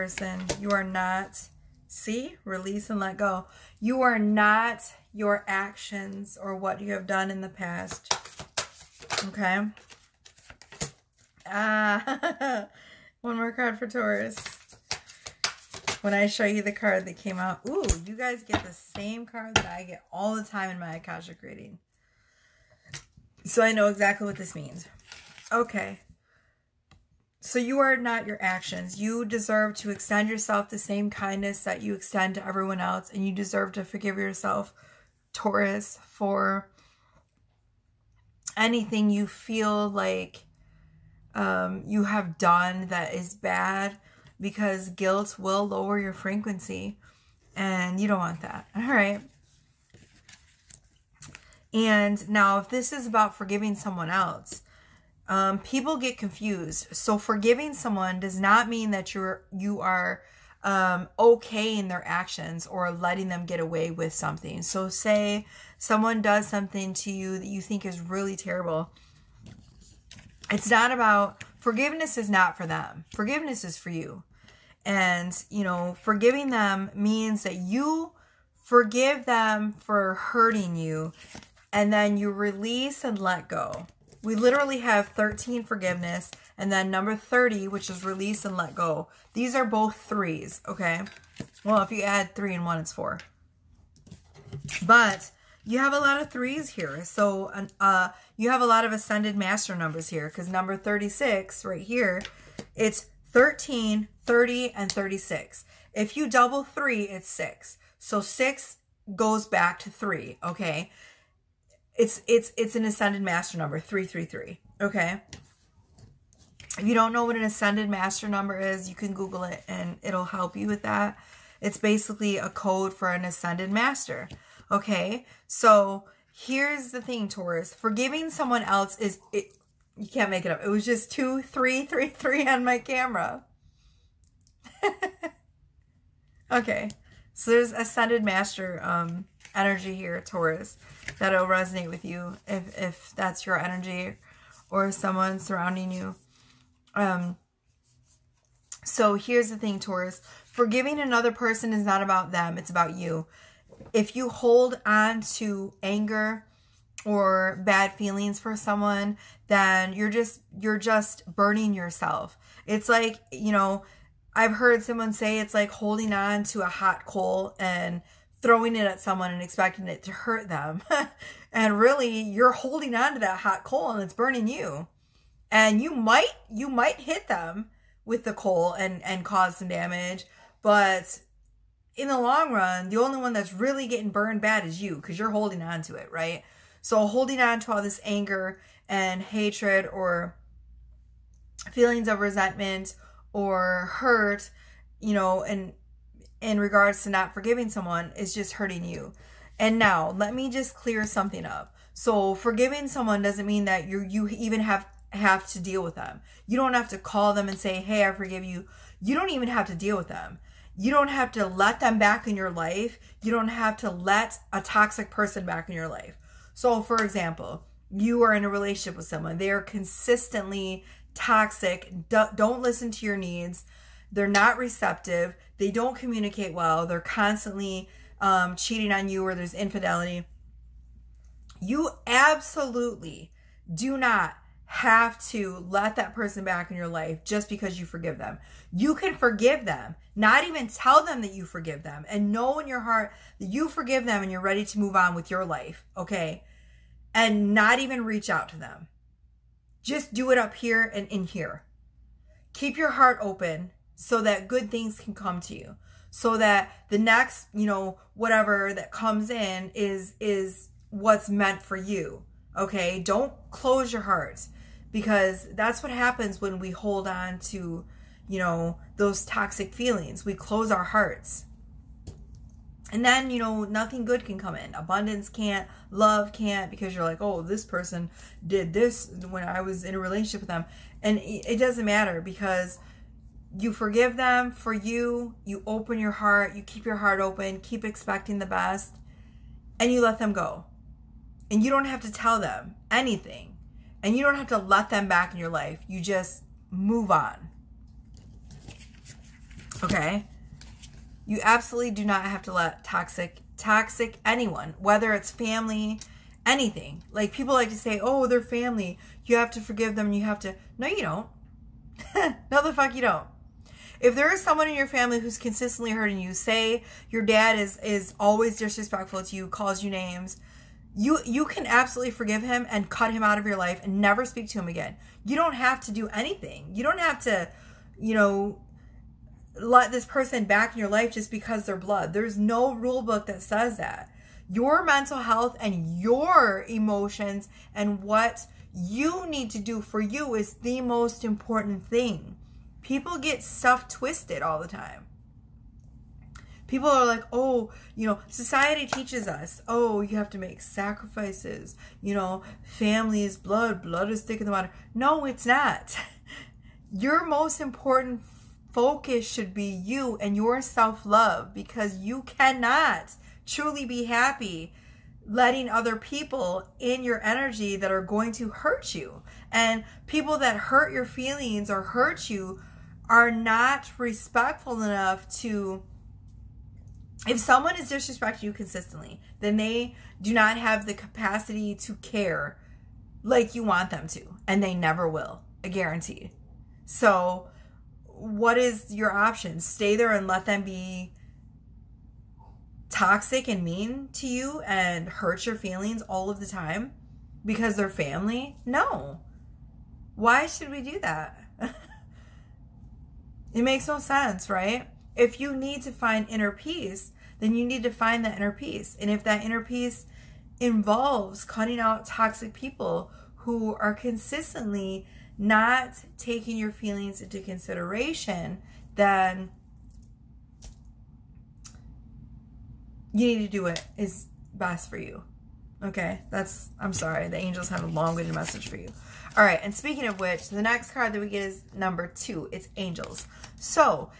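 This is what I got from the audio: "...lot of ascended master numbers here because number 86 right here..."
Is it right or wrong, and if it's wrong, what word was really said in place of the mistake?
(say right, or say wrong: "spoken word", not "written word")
wrong: "36", not "86".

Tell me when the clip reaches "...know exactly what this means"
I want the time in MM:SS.
00:23.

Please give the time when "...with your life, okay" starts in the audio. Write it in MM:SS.
04:05.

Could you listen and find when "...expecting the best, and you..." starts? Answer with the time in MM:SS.
04:47.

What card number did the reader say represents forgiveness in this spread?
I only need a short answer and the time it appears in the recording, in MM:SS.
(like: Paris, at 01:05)
13, at 01:24.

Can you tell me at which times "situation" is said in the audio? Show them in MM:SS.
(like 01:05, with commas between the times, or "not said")
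not said.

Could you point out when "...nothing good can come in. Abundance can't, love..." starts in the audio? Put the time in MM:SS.
04:33.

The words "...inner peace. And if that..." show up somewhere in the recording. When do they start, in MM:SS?
06:48.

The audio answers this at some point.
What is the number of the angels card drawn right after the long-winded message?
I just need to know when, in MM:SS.
07:11.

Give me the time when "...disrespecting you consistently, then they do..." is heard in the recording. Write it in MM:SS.
06:17.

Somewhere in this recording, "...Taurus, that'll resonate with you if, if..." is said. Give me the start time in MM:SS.
02:20.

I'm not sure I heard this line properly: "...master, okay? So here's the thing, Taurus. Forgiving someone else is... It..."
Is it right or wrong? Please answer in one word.
right.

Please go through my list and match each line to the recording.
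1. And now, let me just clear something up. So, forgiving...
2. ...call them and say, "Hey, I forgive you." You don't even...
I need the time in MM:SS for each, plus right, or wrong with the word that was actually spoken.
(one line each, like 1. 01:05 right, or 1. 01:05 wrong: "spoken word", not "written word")
1. 03:19 right
2. 03:26 right.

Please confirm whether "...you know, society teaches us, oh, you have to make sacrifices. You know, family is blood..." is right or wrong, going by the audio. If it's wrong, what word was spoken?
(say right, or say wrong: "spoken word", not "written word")
right.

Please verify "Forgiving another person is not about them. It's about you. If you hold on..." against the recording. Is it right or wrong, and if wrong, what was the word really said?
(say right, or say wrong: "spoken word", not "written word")
right.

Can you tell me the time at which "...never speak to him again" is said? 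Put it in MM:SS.
05:24.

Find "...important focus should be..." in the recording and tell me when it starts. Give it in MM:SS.
05:57.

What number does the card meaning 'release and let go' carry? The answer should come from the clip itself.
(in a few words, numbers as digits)
30.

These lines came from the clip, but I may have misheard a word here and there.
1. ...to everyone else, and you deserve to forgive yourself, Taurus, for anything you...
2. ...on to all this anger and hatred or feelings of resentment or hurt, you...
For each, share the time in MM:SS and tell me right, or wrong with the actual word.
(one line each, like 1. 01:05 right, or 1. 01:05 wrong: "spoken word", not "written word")
1. 00:32 right
2. 03:07 right.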